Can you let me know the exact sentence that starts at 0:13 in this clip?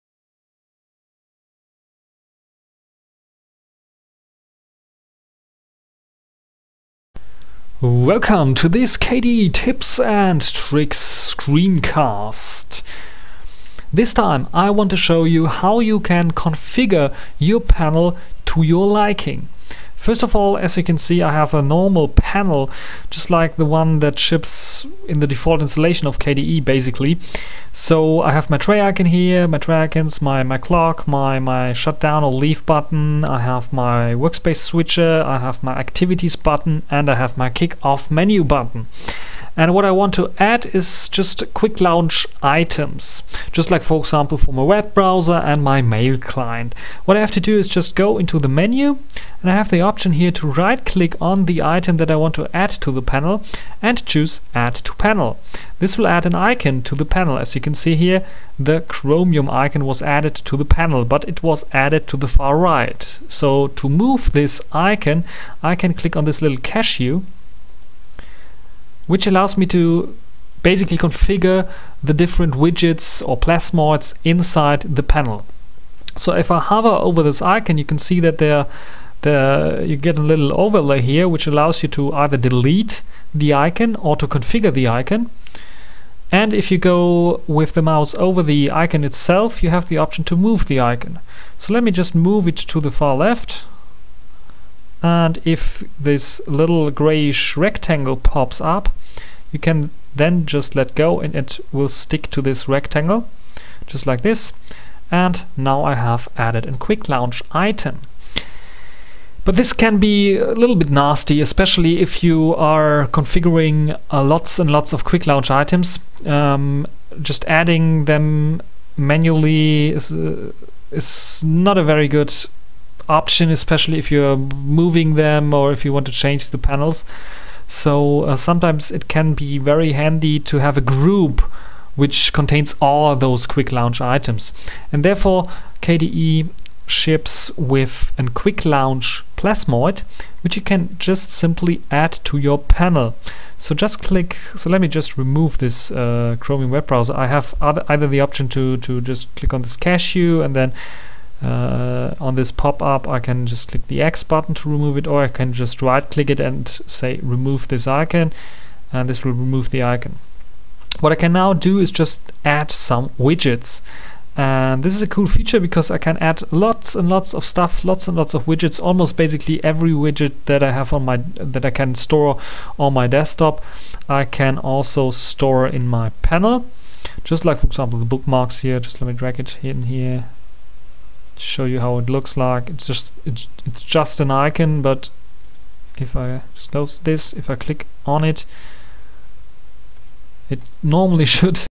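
This time I want to show you how you can configure your panel to your liking.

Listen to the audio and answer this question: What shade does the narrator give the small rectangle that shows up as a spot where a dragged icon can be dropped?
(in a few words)
grayish.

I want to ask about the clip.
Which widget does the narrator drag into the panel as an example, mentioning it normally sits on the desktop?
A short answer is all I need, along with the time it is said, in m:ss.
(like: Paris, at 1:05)
bookmarks, at 2:58.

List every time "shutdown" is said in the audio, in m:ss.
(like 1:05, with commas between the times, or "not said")
0:31.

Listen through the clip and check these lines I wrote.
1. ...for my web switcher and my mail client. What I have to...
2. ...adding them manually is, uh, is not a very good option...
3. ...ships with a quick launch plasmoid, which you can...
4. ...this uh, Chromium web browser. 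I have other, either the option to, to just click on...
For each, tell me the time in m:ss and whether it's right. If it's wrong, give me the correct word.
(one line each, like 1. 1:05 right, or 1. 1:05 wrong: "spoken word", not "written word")
1. 0:44 wrong: "browser", not "switcher"
2. 1:57 right
3. 2:16 right
4. 2:25 right.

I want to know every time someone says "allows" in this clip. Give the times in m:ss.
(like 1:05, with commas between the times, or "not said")
1:09, 1:21.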